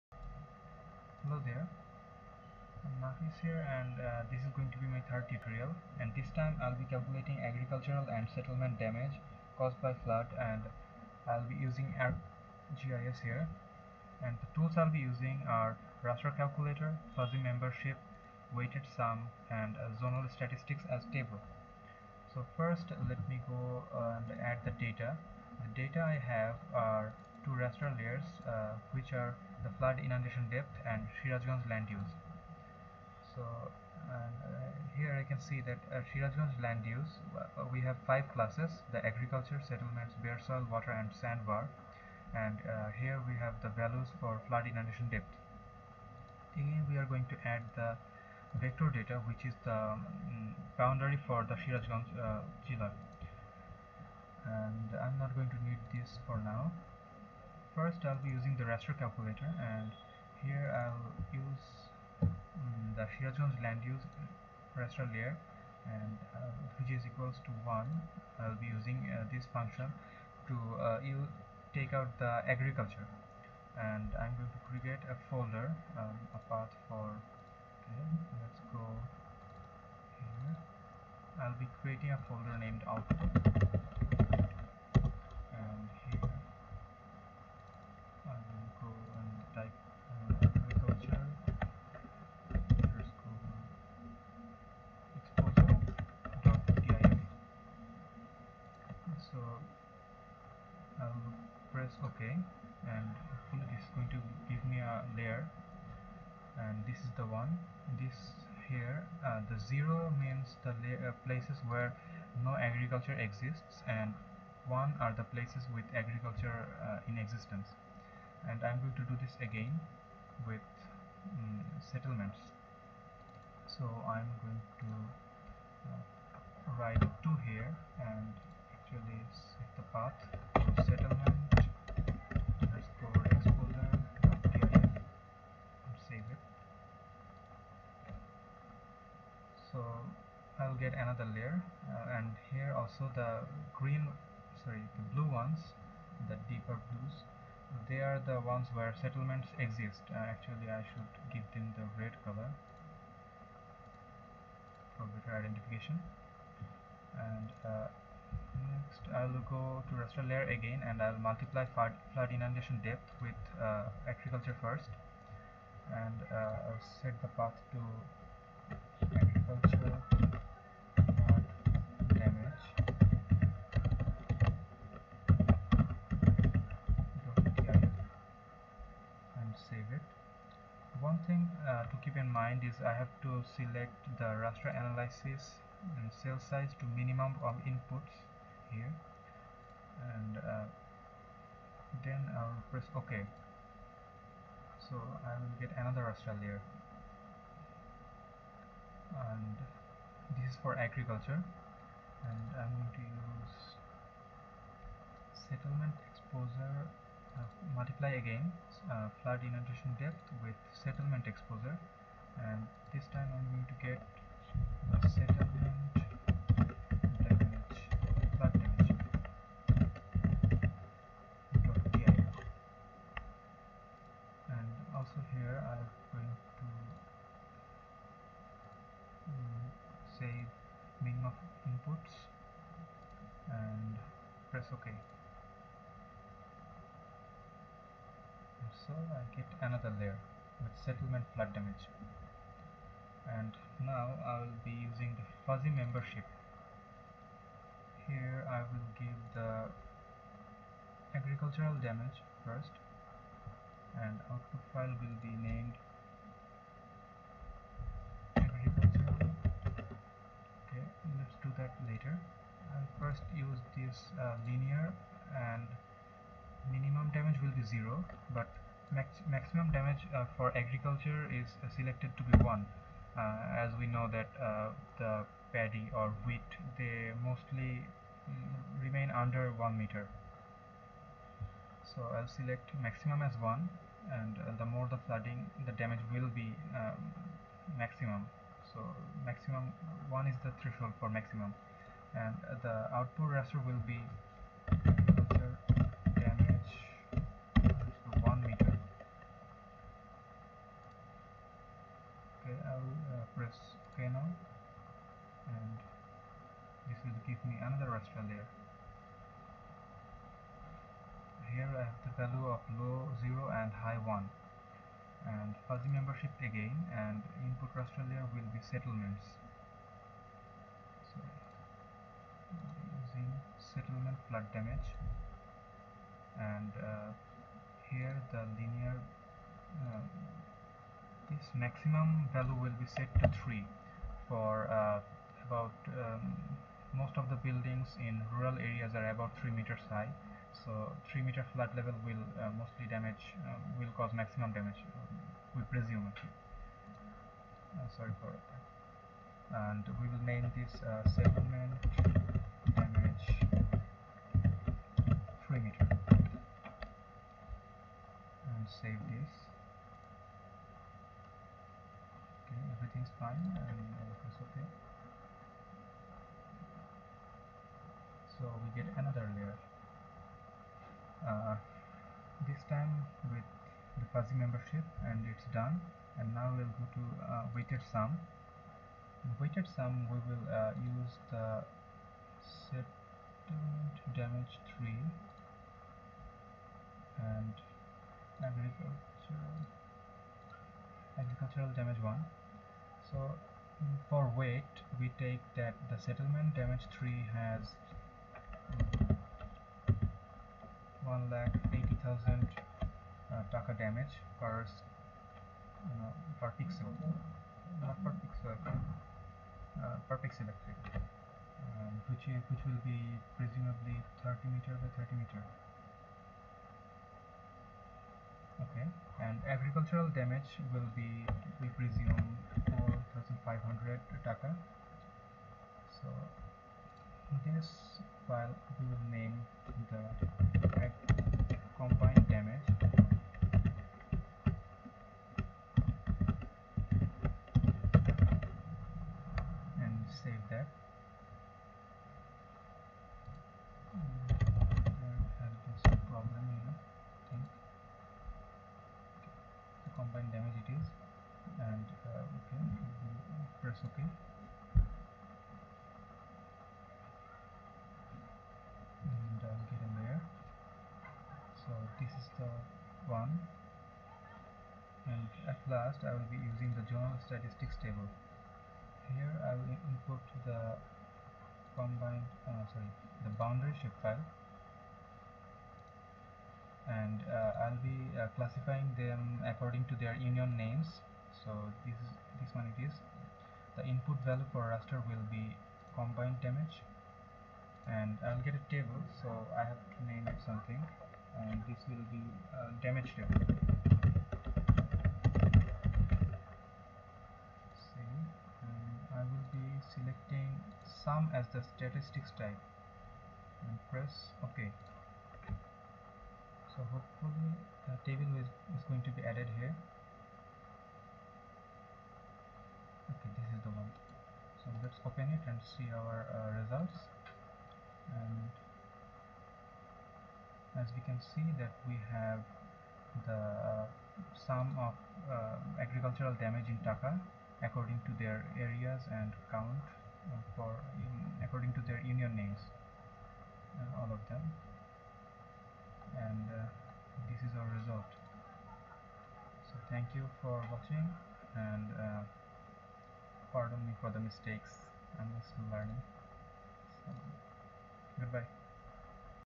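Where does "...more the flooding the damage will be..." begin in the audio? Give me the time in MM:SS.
04:44.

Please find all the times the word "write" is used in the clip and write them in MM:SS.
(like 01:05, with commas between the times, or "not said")
02:06.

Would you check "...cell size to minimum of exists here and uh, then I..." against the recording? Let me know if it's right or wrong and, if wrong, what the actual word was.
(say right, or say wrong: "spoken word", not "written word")
wrong: "inputs", not "exists".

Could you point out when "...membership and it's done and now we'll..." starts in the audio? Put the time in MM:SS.
06:14.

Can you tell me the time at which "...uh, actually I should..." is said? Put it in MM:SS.
02:30.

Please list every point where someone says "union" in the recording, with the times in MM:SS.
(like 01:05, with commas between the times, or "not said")
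08:00, 08:52.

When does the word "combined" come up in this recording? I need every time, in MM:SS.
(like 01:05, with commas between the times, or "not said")
07:51, 08:05.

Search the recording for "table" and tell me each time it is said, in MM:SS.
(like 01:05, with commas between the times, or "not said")
00:21, 07:47, 08:08, 08:13, 08:28.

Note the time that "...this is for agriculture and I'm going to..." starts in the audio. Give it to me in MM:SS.
03:20.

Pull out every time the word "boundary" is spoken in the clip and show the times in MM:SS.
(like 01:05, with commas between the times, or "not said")
00:50, 07:53.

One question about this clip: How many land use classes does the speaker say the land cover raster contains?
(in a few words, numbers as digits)
5.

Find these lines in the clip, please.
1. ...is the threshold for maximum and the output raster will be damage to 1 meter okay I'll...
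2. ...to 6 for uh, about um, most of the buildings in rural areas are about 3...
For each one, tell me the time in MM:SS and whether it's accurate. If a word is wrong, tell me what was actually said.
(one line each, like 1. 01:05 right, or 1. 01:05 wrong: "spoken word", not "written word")
1. 04:50 right
2. 05:33 wrong: "3", not "6".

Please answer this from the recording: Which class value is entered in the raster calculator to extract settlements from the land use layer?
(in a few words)
2.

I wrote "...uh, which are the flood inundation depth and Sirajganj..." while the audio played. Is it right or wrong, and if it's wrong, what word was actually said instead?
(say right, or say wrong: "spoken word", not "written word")
right.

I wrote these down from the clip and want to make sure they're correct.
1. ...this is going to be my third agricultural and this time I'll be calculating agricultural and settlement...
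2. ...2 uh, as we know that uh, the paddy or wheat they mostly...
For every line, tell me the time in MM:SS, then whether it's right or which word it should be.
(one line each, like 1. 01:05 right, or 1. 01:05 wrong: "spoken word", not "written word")
1. 00:04 wrong: "tutorial", not "agricultural"
2. 04:32 wrong: "1", not "2".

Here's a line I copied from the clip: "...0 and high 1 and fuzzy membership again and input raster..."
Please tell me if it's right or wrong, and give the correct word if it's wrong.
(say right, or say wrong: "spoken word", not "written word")
right.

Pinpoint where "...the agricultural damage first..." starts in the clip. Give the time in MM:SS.
04:09.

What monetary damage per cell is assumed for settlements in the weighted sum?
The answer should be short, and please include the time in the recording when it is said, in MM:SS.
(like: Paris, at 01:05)
180,000 taka, at 06:41.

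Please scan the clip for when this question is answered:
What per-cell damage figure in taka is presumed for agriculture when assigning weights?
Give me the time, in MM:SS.
07:03.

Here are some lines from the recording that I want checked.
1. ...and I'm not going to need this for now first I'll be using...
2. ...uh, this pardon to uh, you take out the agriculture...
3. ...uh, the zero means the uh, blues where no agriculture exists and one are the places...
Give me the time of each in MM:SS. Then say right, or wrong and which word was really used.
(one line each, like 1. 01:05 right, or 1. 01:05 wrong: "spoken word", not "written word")
1. 00:54 right
2. 01:09 wrong: "function", not "pardon"
3. 01:49 wrong: "places", not "blues".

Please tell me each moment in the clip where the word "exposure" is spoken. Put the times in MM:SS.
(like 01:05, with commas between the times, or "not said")
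03:26, 03:31.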